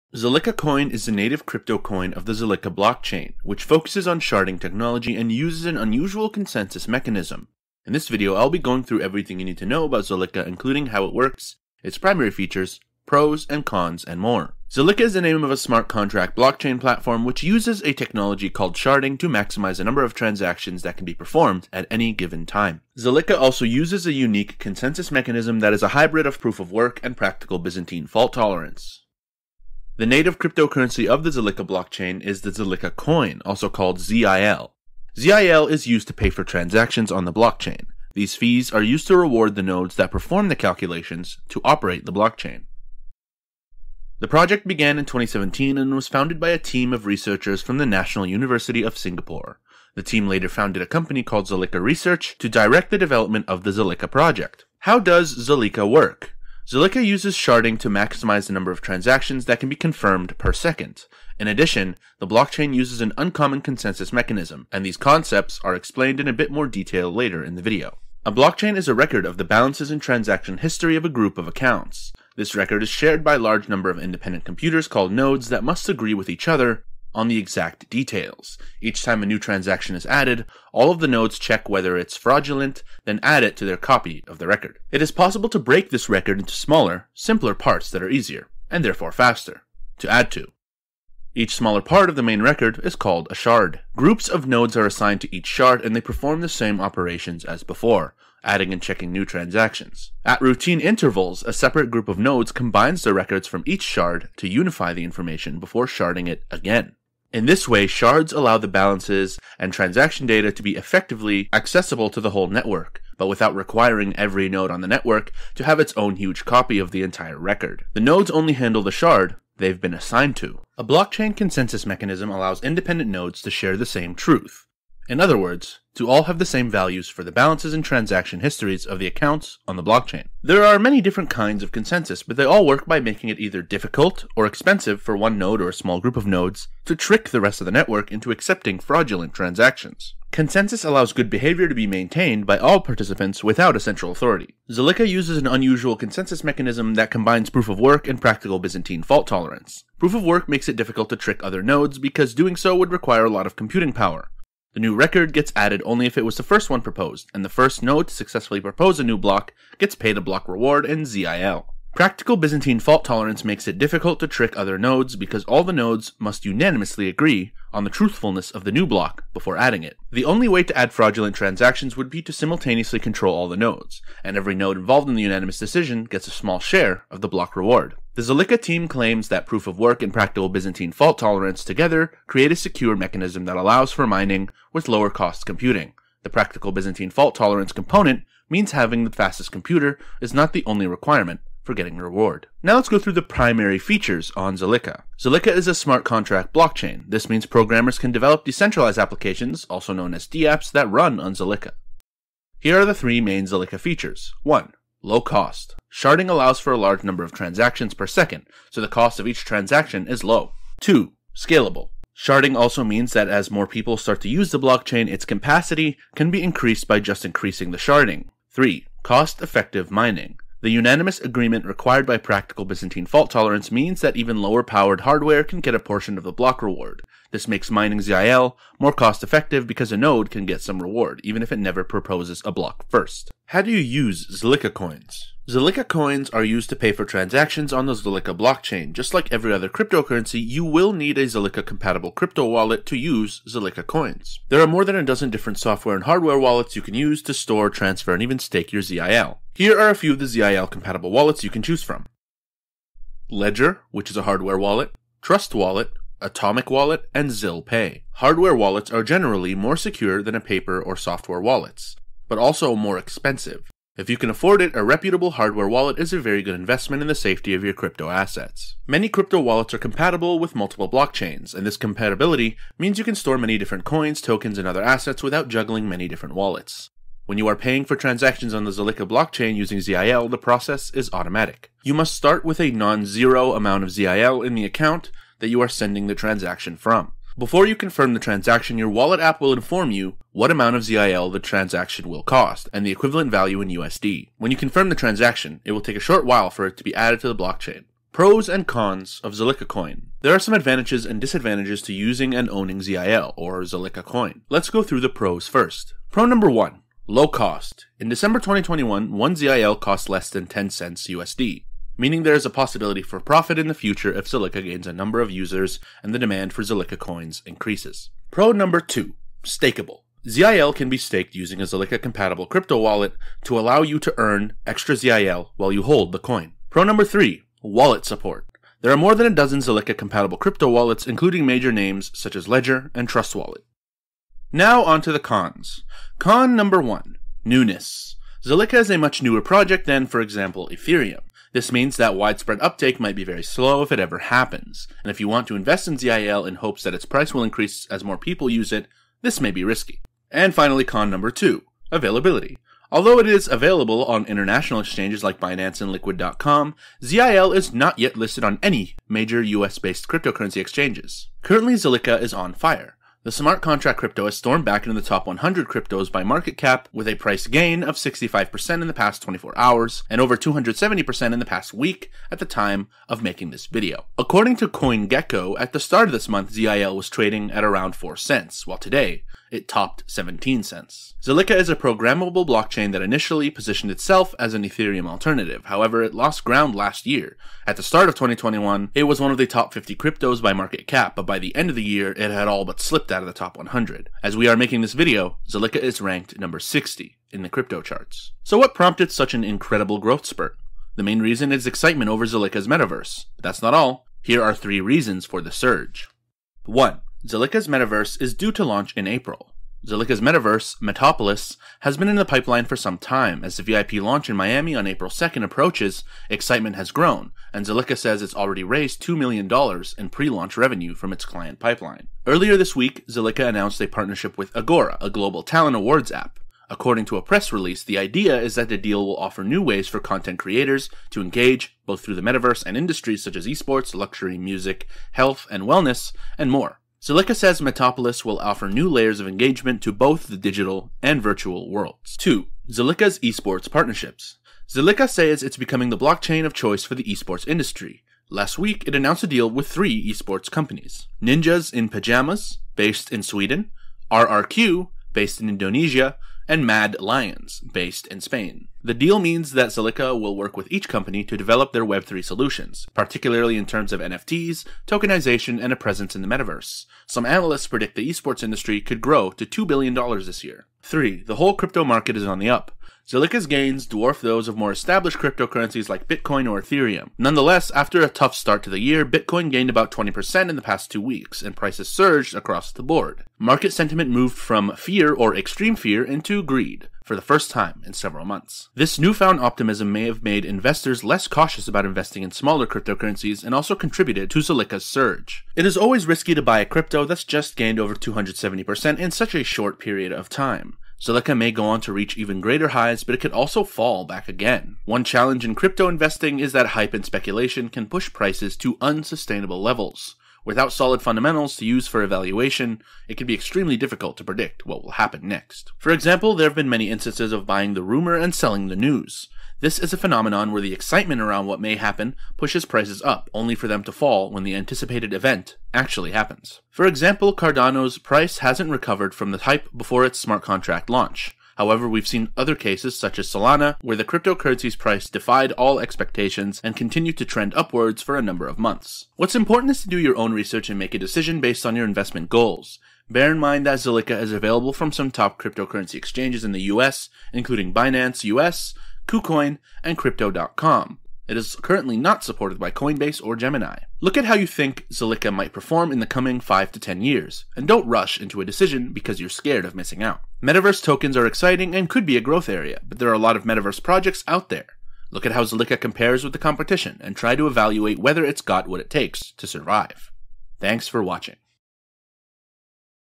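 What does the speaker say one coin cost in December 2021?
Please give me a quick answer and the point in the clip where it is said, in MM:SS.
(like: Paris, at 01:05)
10 cents, at 05:10.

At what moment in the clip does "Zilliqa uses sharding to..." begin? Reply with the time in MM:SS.
00:56.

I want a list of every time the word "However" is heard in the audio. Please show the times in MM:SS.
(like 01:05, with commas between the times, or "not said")
06:25, 08:51.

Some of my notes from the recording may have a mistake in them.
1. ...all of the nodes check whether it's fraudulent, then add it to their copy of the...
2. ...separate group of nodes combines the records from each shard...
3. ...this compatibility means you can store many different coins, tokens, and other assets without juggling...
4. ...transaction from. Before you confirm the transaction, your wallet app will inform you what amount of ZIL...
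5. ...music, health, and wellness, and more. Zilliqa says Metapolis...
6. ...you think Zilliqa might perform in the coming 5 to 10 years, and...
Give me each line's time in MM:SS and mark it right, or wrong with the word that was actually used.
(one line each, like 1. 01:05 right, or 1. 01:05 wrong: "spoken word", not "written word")
1. 01:20 right
2. 01:41 right
3. 04:31 right
4. 04:46 right
5. 07:14 right
6. 09:14 right.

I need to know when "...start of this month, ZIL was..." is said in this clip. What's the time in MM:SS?
06:15.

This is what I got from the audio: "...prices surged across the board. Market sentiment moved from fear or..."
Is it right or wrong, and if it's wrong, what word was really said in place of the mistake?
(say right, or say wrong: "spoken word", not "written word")
right.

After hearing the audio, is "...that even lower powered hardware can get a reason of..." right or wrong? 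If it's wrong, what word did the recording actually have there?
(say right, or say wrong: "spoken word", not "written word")
wrong: "portion", not "reason".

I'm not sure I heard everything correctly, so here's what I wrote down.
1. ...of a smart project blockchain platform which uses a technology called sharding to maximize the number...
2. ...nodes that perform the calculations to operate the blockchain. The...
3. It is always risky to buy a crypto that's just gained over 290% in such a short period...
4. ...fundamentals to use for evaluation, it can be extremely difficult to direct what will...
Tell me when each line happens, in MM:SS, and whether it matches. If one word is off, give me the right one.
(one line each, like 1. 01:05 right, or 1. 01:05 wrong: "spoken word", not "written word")
1. 00:15 wrong: "contract", not "project"
2. 00:39 right
3. 08:15 wrong: "270", not "290"
4. 08:31 wrong: "predict", not "direct".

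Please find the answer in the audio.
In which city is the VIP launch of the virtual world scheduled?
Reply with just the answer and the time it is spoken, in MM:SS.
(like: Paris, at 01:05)
Miami, at 06:54.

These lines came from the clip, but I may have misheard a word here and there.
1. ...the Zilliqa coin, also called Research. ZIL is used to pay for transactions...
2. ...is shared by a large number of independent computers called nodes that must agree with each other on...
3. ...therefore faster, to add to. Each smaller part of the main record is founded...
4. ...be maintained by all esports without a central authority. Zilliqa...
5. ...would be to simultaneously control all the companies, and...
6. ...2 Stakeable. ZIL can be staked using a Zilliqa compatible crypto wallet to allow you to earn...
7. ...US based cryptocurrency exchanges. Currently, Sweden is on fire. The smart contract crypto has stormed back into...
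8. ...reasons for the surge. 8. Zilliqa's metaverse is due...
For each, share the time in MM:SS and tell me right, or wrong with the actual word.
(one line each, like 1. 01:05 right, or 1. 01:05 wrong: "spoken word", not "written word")
1. 00:32 wrong: "ZIL", not "Research"
2. 01:12 right
3. 01:28 wrong: "called", not "founded"
4. 02:21 wrong: "participants", not "esports"
5. 02:51 wrong: "nodes", not "companies"
6. 05:18 right
7. 05:59 wrong: "Zilliqa", not "Sweden"
8. 06:44 wrong: "1", not "8".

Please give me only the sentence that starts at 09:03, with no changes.
Bear in mind that Zilliqa is available from some top cryptocurrency exchanges in the US, including Binance US, KuCoin, and Crypto.com.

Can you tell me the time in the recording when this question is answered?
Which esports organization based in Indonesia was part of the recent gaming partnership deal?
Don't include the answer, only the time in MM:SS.
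07:34.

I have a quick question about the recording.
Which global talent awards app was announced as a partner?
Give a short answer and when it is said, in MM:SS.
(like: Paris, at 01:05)
Agora, at 07:04.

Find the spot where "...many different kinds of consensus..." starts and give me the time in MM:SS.
02:10.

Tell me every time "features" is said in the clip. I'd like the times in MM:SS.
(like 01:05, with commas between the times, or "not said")
00:12, 03:13, 03:23.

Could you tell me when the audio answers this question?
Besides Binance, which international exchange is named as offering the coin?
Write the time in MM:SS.
05:55.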